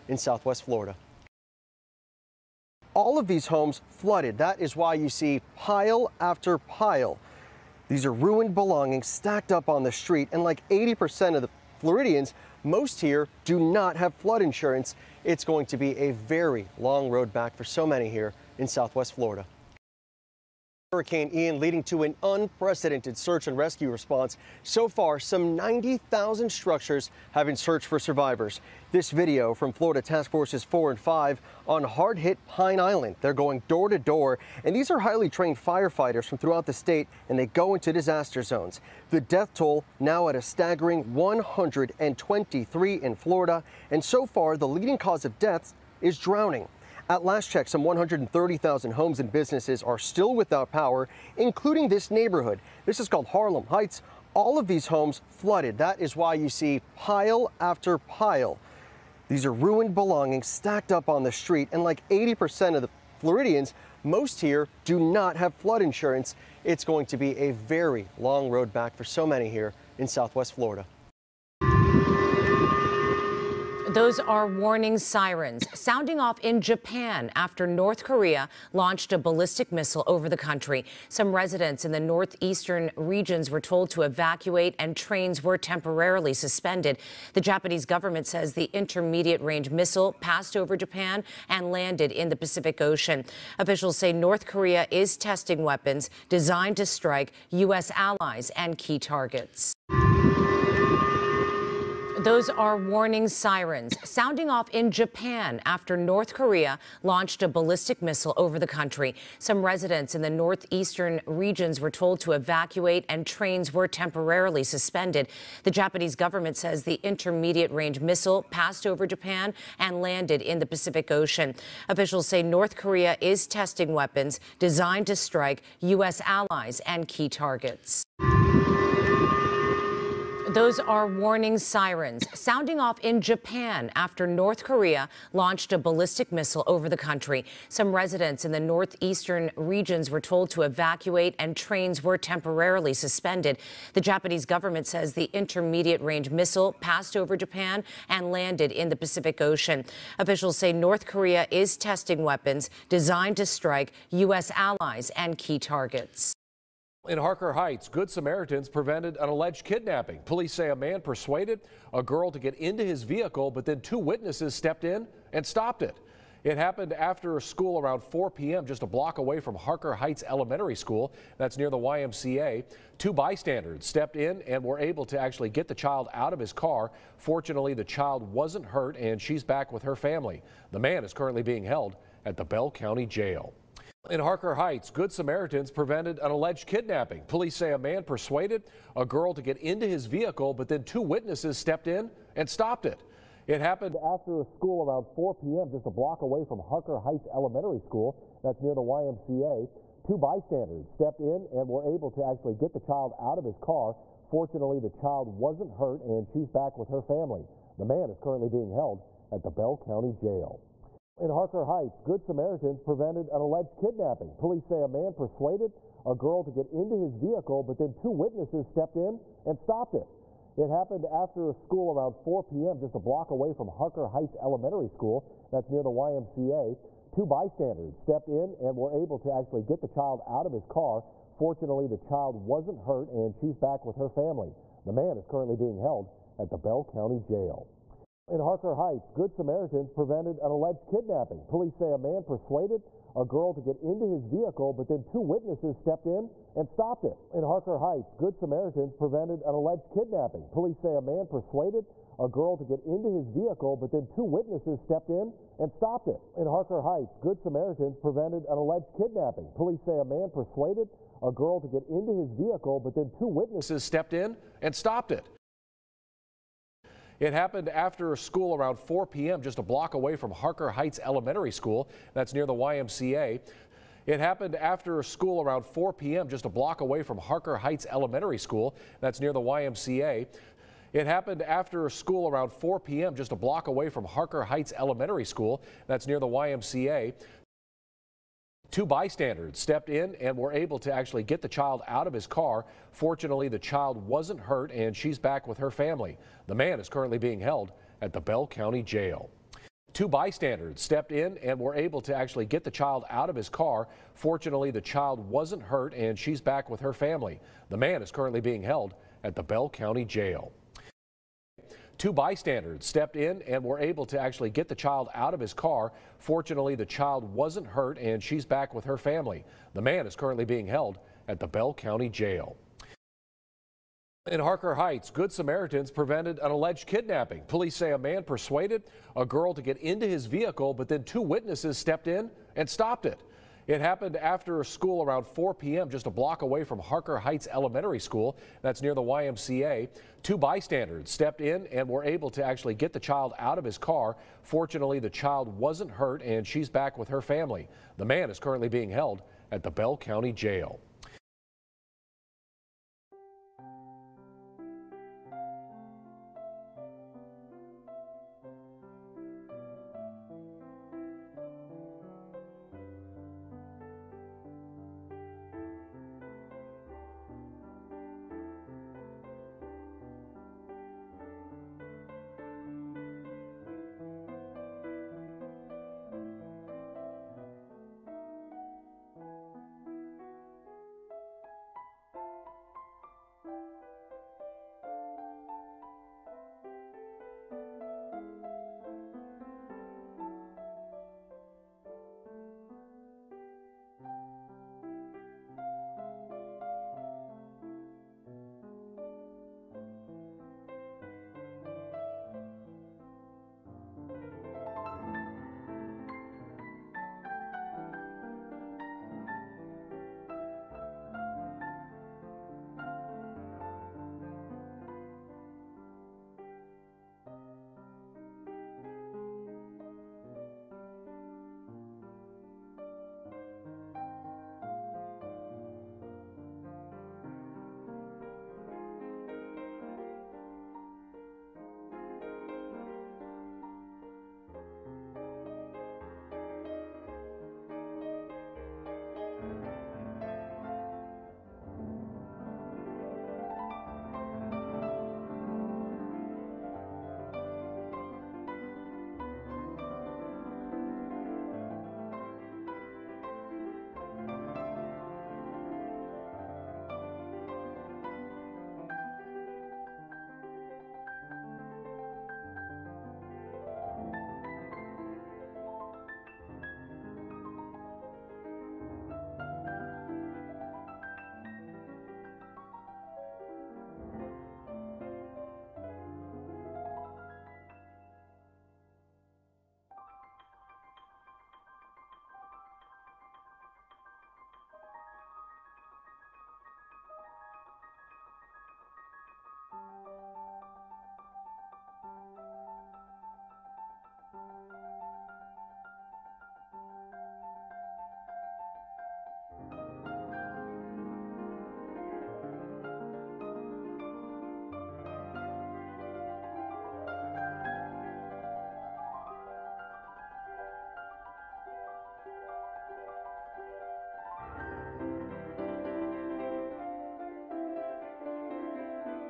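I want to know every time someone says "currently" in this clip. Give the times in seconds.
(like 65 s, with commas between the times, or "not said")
181 s, 208 s, 235 s, 296 s, 308 s, 320 s, 348 s.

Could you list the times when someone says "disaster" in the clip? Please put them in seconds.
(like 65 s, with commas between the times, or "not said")
37 s.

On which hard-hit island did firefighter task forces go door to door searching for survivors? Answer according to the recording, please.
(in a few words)
Pine Island.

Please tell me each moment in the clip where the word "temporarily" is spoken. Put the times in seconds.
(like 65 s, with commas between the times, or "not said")
85 s, 113 s, 142 s.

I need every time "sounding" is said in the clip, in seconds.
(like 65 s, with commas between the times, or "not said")
75 s, 104 s, 132 s.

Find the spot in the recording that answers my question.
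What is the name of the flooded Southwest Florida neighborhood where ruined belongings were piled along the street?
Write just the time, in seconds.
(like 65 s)
53 s.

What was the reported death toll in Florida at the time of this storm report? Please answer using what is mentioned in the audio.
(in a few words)
123.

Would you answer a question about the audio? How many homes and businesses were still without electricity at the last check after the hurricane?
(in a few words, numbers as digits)
130,000.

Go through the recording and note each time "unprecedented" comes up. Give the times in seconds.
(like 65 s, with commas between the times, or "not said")
22 s.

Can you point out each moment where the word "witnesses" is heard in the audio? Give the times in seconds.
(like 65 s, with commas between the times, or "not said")
163 s, 191 s, 218 s, 245 s, 254 s, 263 s, 331 s.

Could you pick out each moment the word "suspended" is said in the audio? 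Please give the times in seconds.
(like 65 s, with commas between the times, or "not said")
86 s, 114 s, 142 s.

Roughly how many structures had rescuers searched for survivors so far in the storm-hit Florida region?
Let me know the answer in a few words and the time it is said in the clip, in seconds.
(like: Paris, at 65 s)
90,000, at 25 s.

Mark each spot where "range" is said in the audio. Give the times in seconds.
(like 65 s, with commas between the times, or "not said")
89 s, 117 s, 145 s.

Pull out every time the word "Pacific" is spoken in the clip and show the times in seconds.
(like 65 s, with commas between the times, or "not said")
92 s, 120 s, 148 s.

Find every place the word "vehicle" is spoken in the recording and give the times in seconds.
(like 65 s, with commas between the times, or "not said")
163 s, 190 s, 217 s, 244 s, 253 s, 262 s, 330 s.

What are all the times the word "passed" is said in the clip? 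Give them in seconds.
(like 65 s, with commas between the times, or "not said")
90 s, 118 s, 146 s.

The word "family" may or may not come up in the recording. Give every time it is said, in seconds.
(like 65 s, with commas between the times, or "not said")
179 s, 207 s, 234 s, 295 s, 306 s, 318 s, 347 s.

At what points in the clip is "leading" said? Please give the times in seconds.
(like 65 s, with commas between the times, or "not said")
21 s, 44 s.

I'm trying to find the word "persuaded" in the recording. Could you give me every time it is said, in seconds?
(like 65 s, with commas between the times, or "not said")
160 s, 188 s, 215 s, 242 s, 251 s, 260 s, 328 s.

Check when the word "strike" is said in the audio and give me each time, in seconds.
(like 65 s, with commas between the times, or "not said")
96 s, 125 s, 153 s.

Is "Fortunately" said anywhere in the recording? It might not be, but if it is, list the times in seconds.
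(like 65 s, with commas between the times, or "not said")
177 s, 204 s, 231 s, 292 s, 304 s, 316 s, 344 s.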